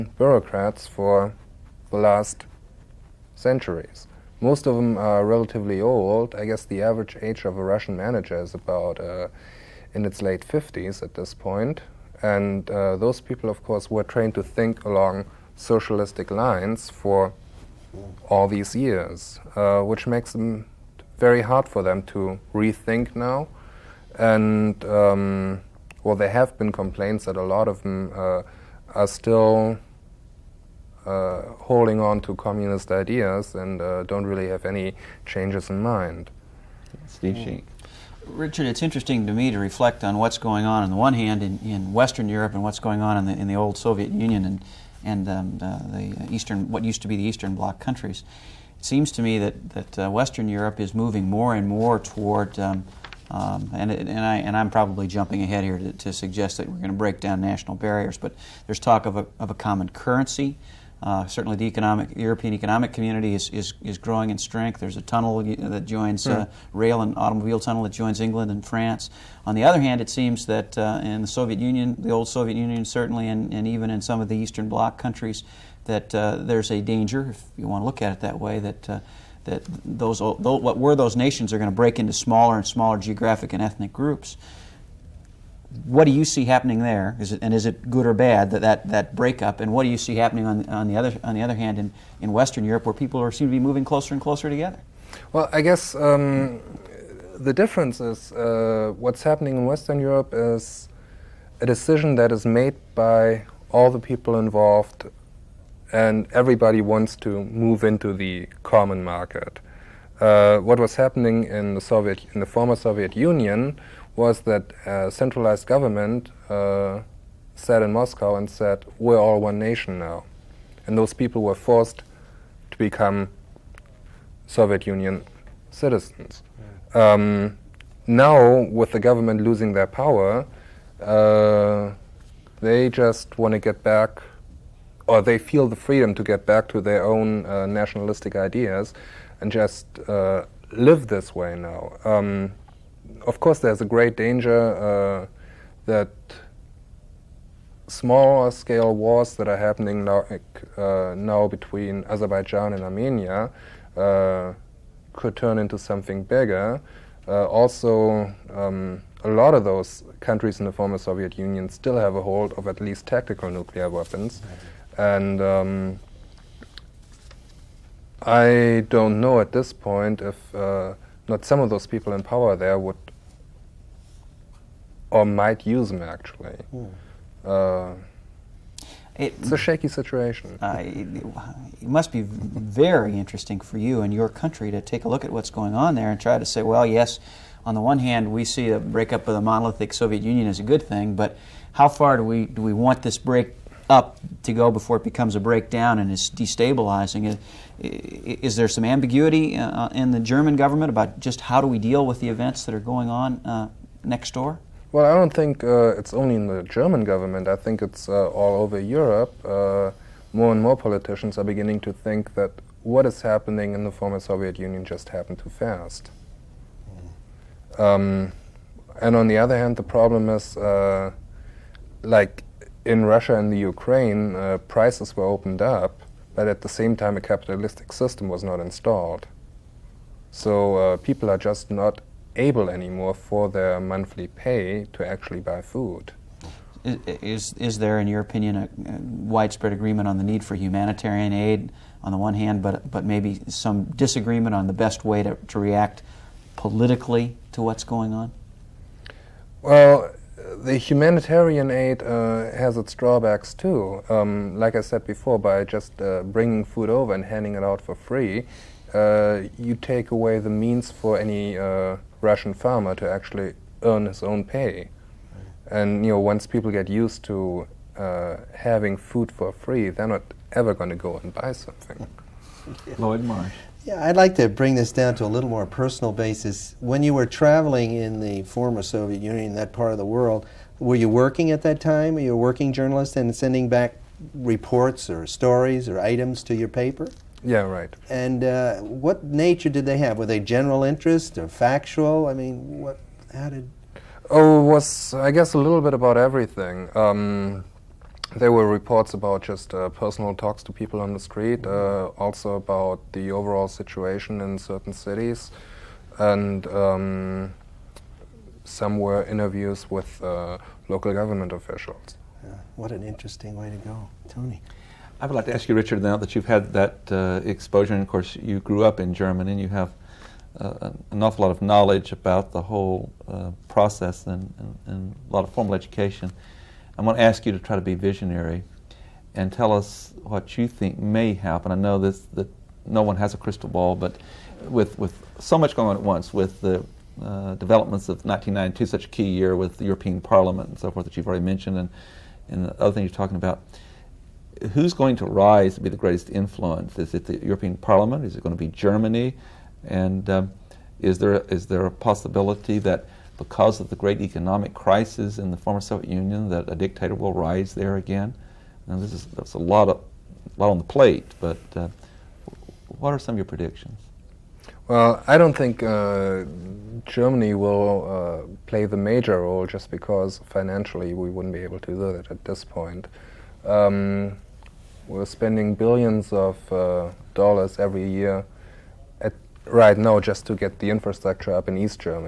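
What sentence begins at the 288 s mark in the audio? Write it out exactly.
And uh, what nature did they have?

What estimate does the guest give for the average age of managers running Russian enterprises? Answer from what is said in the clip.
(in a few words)
late 50s.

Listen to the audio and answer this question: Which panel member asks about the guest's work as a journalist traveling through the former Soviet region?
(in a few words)
Lloyd Marsh.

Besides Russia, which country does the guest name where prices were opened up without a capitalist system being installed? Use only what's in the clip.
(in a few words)
Ukraine.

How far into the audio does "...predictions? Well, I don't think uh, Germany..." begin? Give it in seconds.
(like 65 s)
363 s.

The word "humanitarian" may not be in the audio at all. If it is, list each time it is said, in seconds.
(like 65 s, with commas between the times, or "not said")
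240 s, 250 s.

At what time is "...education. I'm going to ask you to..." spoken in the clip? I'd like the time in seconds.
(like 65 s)
325 s.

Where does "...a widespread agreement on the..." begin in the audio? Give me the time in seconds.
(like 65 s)
238 s.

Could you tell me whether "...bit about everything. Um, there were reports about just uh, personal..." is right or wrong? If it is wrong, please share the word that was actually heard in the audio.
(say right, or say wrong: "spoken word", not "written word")
right.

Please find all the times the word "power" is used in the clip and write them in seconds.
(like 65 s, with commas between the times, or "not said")
129 s, 172 s.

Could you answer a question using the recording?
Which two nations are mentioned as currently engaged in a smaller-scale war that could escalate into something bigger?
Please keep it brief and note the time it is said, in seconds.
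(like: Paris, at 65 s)
Azerbaijan and Armenia, at 152 s.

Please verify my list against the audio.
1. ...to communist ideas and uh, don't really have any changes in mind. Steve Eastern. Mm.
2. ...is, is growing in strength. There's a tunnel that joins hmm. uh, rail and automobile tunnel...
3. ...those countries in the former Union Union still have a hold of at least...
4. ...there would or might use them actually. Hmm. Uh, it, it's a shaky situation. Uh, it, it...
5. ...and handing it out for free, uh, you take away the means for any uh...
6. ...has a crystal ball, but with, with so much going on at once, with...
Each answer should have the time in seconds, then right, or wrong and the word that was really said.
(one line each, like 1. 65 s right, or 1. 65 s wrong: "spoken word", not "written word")
1. 32 s wrong: "Schink", not "Eastern"
2. 63 s right
3. 159 s wrong: "Soviet", not "Union"
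4. 172 s right
5. 257 s right
6. 333 s right.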